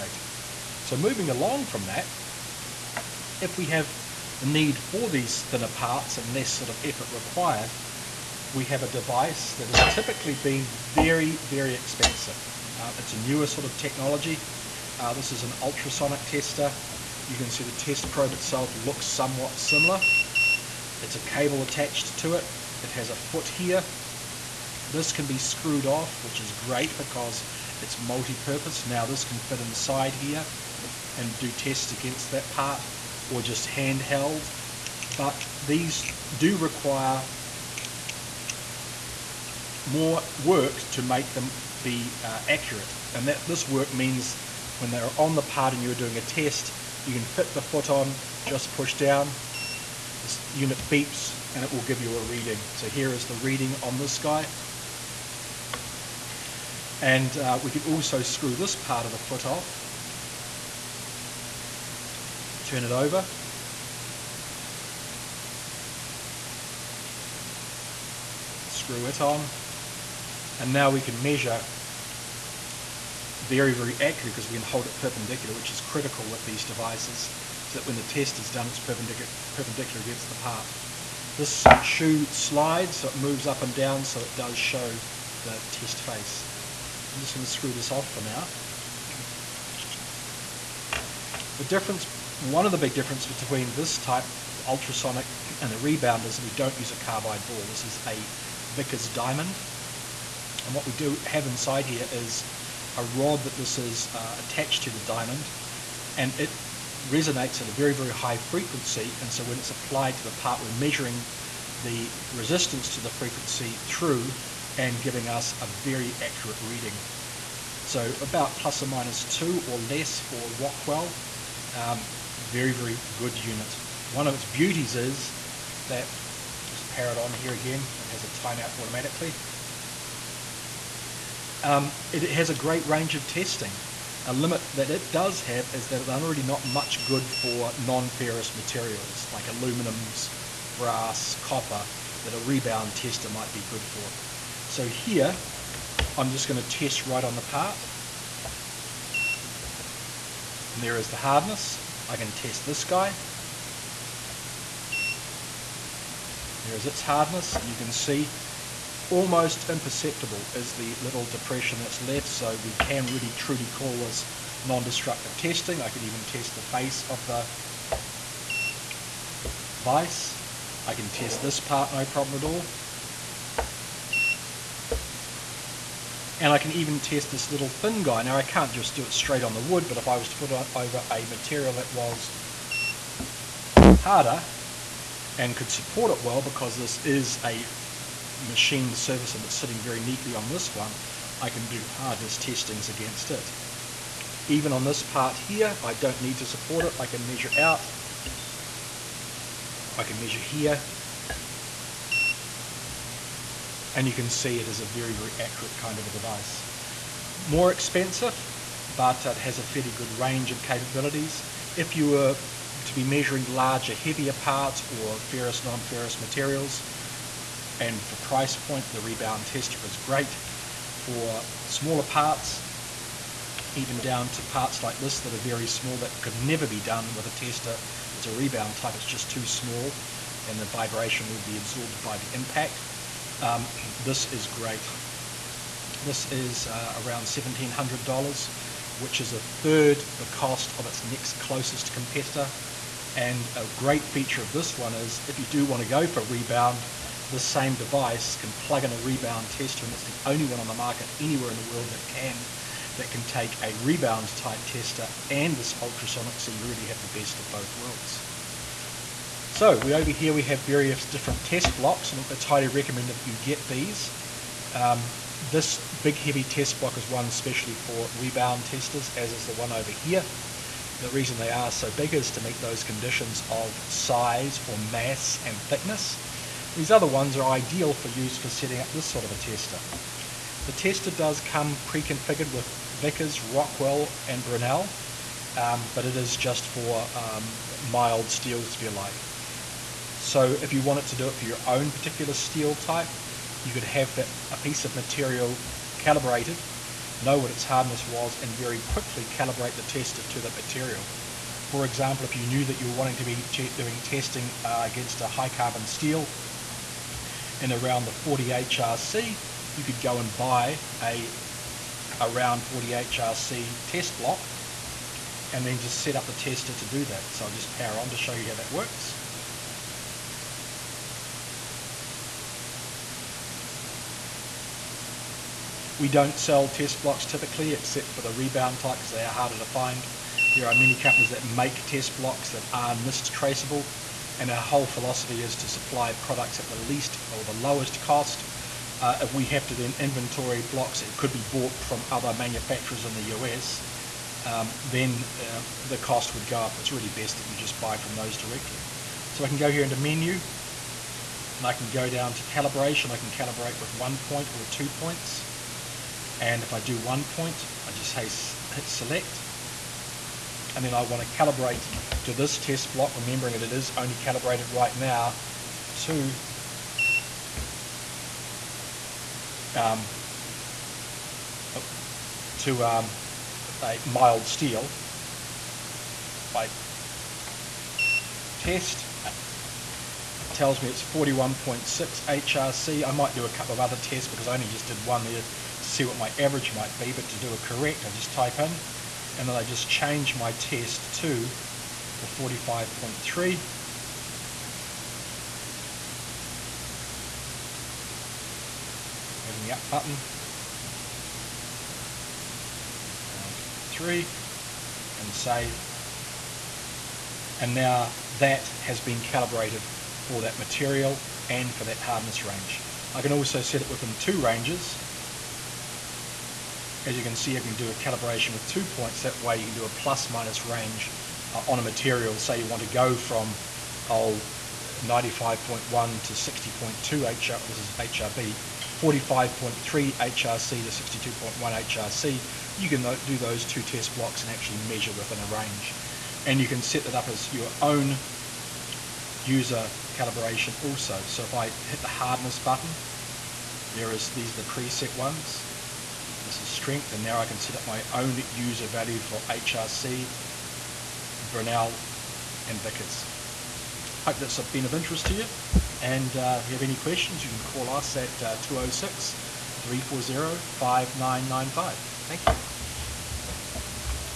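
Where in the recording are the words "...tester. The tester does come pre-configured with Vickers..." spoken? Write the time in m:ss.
4:39.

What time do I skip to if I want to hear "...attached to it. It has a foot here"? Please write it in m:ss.
0:21.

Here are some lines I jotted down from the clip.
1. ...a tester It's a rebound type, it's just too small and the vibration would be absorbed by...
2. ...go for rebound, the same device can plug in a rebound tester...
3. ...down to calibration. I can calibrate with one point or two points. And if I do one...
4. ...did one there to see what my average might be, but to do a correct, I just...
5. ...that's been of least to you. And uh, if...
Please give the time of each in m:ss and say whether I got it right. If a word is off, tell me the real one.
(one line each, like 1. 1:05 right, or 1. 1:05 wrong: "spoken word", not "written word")
1. 3:47 right
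2. 4:05 right
3. 5:52 right
4. 6:24 right
5. 7:34 wrong: "interest", not "least".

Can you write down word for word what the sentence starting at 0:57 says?
And uh, we can also screw this part of the foot off turn it over.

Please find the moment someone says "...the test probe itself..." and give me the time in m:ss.
0:17.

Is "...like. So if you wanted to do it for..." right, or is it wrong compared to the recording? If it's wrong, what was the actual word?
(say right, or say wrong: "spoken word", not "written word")
right.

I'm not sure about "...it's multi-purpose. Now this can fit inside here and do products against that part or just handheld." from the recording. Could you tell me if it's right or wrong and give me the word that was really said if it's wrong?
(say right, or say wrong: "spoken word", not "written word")
wrong: "tests", not "products".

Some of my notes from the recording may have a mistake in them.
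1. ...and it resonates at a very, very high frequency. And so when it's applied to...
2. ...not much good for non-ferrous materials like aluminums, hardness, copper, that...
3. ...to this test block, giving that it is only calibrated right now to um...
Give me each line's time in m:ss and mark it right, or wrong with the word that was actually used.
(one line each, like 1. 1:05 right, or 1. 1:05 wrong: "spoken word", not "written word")
1. 1:46 right
2. 2:16 wrong: "brass", not "hardness"
3. 6:02 wrong: "remembering", not "giving".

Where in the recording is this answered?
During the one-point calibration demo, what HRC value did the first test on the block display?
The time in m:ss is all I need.
6:21.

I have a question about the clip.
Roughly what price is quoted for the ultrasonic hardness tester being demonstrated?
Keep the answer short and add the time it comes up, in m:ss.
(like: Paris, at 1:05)
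$1,700, at 3:57.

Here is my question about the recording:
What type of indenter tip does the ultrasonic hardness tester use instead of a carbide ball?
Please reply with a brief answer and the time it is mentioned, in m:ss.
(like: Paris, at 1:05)
Vickers diamond, at 1:38.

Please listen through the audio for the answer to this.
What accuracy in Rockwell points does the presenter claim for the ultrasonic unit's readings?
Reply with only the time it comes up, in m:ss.
1:58.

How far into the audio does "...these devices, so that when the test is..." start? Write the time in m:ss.
1:16.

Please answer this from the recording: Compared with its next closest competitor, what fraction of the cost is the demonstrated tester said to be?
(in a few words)
a third.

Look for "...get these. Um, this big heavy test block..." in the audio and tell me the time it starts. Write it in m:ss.
4:23.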